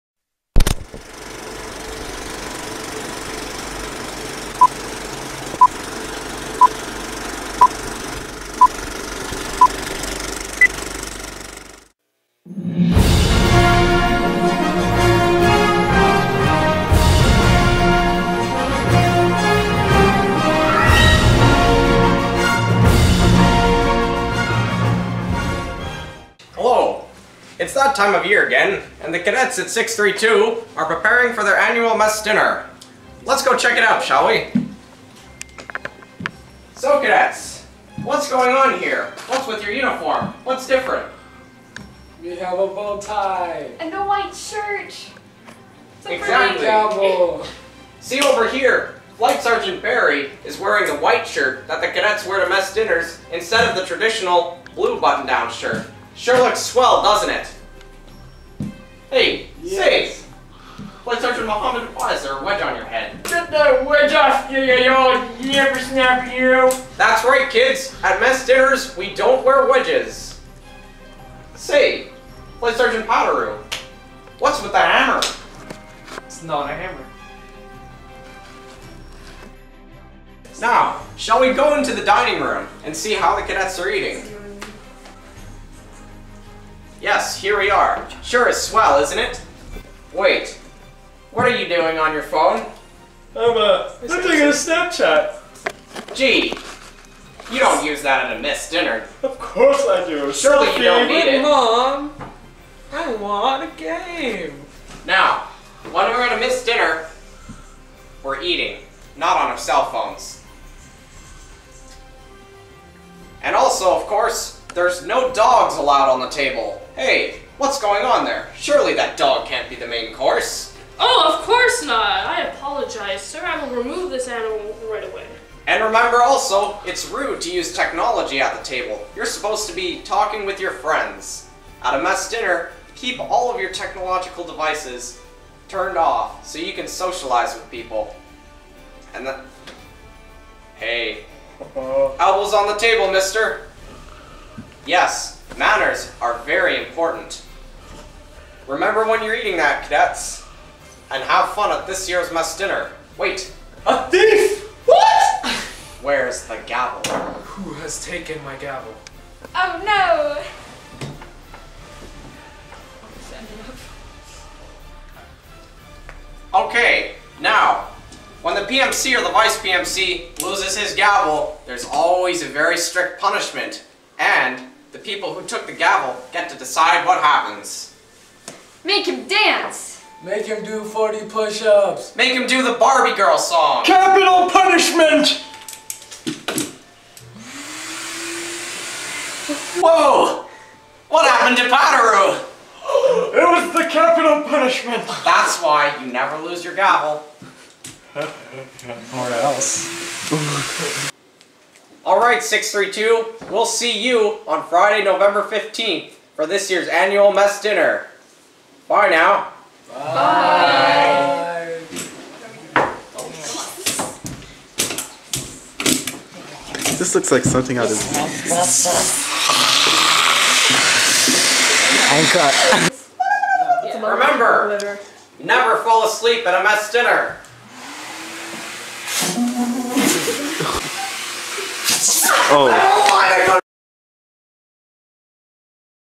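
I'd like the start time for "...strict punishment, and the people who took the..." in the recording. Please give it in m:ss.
2:52.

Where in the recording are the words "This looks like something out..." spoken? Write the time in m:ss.
3:36.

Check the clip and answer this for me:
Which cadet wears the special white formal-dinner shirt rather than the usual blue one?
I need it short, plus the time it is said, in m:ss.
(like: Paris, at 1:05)
Flight Sergeant Barry, at 0:49.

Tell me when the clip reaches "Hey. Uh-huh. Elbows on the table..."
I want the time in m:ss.
2:20.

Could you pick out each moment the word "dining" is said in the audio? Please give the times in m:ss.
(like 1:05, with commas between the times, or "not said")
1:22.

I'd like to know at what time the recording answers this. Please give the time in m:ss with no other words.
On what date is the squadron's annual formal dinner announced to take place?
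3:24.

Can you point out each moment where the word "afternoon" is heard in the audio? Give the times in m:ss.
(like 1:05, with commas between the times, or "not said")
not said.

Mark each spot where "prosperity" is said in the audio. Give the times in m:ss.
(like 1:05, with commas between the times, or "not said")
not said.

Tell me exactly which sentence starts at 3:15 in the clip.
That's why you never lose your gavel.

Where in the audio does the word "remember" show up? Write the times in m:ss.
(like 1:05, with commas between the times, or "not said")
2:05, 2:28, 3:44.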